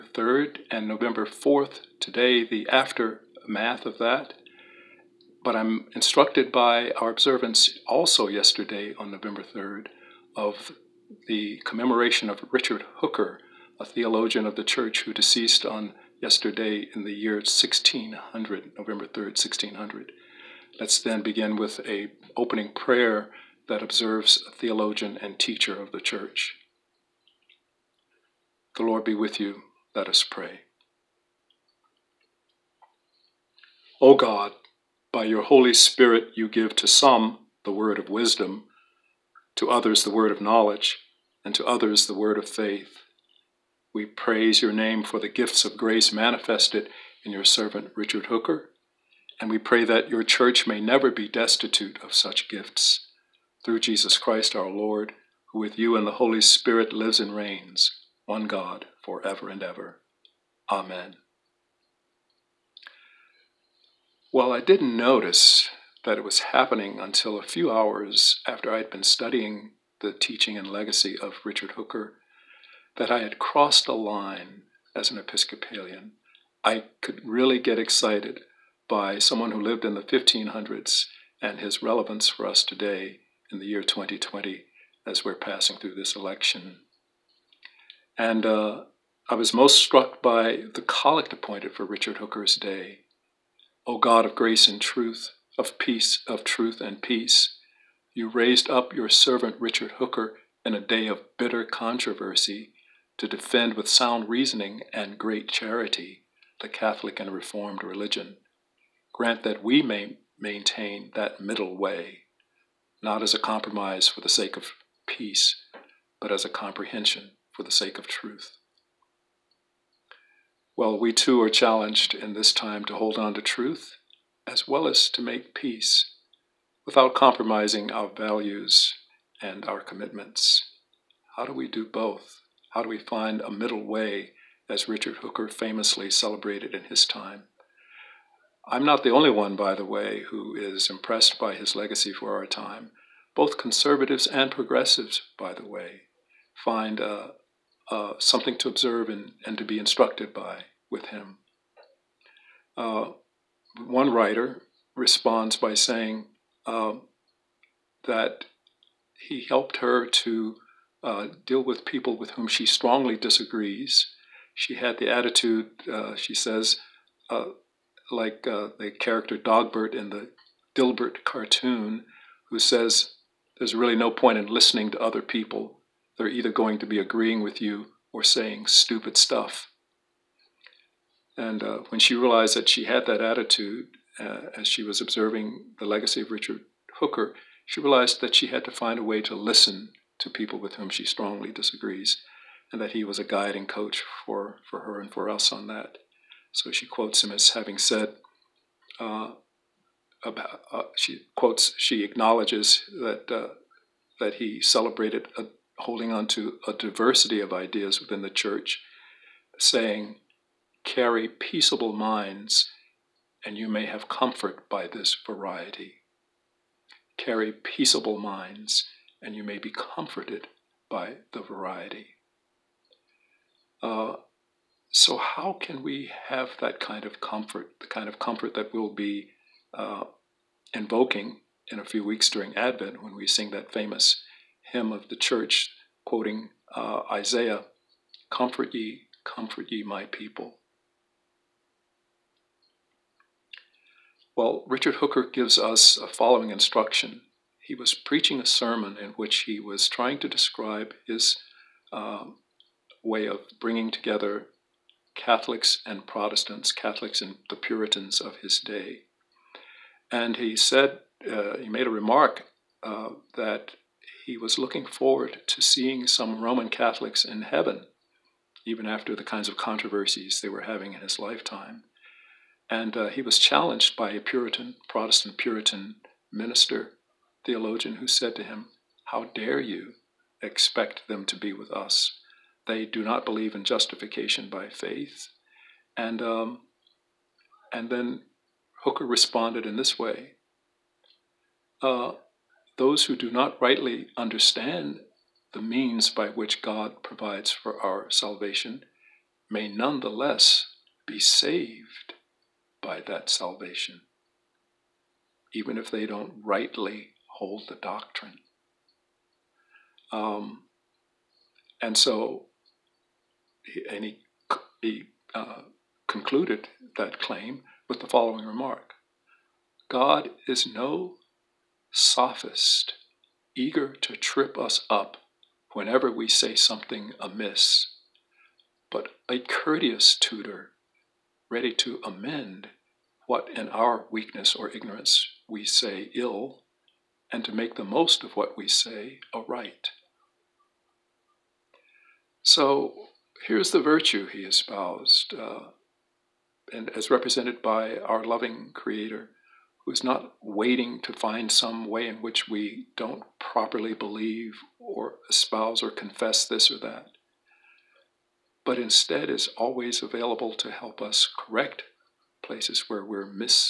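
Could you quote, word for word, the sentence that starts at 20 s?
Let's then begin with a opening prayer that observes a theologian and teacher of the church.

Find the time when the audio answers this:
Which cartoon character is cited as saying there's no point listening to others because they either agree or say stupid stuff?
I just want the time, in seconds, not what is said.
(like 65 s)
169 s.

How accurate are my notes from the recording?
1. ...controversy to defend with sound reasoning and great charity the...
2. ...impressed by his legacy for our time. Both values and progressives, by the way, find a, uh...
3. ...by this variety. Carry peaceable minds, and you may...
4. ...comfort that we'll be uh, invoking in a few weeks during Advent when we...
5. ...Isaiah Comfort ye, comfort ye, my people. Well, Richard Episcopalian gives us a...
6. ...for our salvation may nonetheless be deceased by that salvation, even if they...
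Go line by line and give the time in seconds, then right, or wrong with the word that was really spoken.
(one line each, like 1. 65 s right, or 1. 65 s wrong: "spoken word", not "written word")
1. 101 s right
2. 140 s wrong: "conservatives", not "values"
3. 214 s right
4. 228 s right
5. 237 s wrong: "Hooker", not "Episcopalian"
6. 297 s wrong: "saved", not "deceased".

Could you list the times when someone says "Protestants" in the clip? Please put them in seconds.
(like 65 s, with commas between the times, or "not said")
256 s, 274 s.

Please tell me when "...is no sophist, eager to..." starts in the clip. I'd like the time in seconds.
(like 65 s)
320 s.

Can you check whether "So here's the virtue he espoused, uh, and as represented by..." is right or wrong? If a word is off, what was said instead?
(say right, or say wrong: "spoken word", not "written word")
right.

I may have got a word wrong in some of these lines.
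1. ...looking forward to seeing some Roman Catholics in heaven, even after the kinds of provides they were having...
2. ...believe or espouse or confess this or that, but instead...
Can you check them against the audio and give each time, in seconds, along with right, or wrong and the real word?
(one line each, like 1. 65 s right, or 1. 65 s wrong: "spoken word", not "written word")
1. 264 s wrong: "controversies", not "provides"
2. 353 s right.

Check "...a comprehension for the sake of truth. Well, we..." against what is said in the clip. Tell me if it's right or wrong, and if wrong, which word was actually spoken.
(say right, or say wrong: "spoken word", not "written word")
right.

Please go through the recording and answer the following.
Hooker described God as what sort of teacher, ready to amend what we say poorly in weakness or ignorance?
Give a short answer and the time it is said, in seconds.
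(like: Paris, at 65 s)
A courteous tutor, at 329 s.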